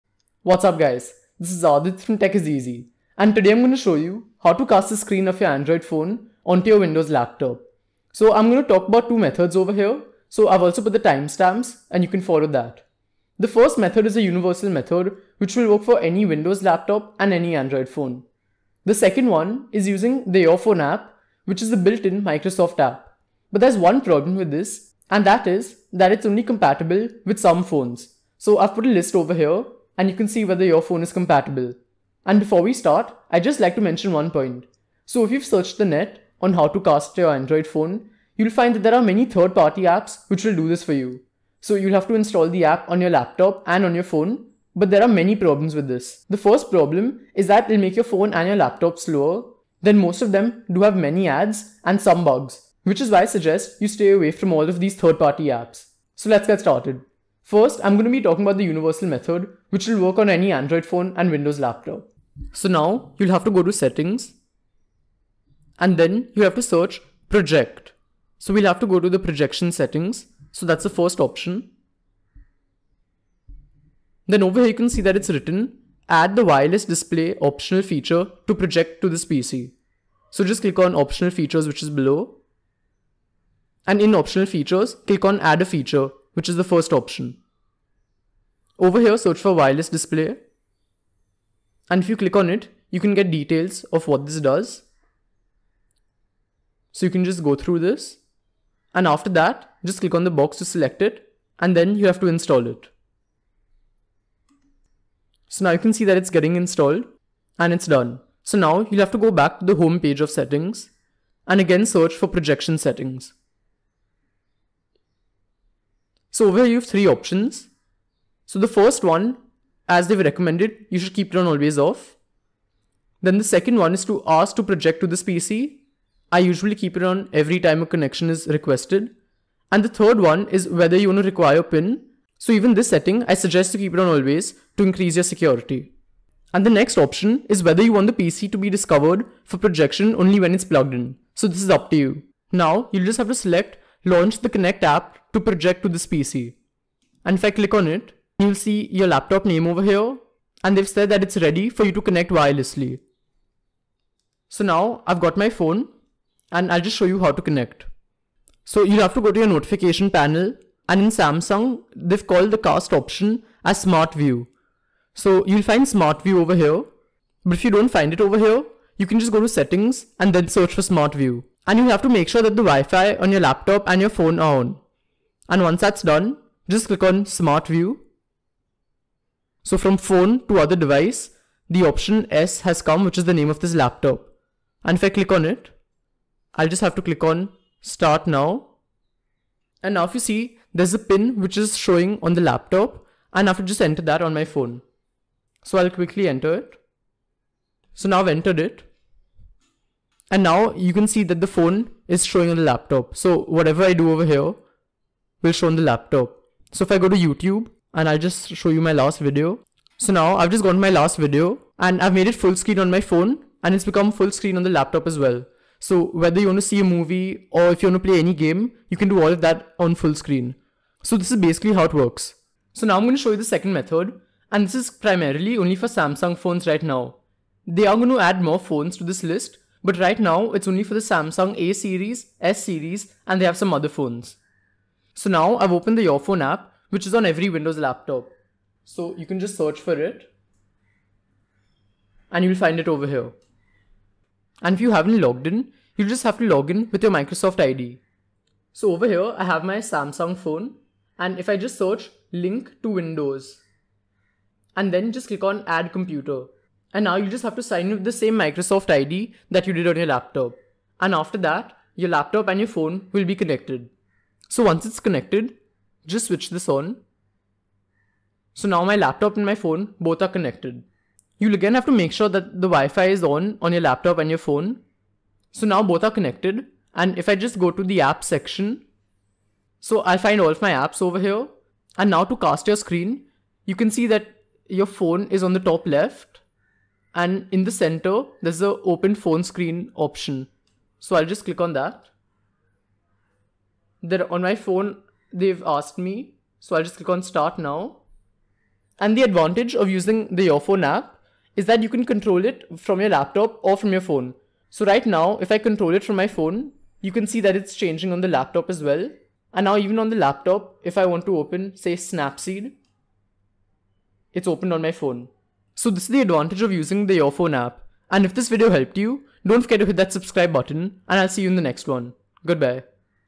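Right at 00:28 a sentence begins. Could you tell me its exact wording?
So I've put a list over here and you can see whether your phone is compatible.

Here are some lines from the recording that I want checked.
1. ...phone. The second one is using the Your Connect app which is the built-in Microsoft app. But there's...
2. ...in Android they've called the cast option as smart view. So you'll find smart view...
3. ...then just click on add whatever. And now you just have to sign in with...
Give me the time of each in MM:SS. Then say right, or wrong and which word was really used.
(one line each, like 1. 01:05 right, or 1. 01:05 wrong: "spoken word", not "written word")
1. 00:17 wrong: "Phone", not "Connect"
2. 02:41 wrong: "Samsung", not "Android"
3. 04:14 wrong: "computer", not "whatever".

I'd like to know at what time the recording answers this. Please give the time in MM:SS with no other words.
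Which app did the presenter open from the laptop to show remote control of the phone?
05:11.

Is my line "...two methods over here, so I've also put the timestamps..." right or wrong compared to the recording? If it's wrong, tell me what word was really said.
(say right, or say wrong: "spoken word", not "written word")
right.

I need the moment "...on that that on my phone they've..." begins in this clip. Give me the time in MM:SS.
04:51.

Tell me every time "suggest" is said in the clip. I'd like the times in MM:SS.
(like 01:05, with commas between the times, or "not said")
00:53, 02:13.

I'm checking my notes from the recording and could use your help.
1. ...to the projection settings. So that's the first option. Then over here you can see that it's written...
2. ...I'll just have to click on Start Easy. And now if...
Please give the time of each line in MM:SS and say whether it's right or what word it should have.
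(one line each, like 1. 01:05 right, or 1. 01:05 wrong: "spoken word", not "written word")
1. 01:08 right
2. 03:06 wrong: "Now", not "Easy".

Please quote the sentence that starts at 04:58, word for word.
And the advantage of using the Your Phone app is that you can control it from your laptop or from your phone.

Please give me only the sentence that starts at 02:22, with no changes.
Now, you'll just have to select launch the Connect app to project to this PC.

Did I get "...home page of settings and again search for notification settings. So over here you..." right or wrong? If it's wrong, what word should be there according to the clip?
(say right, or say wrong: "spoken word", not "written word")
wrong: "projection", not "notification".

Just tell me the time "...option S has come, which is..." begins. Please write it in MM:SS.
03:01.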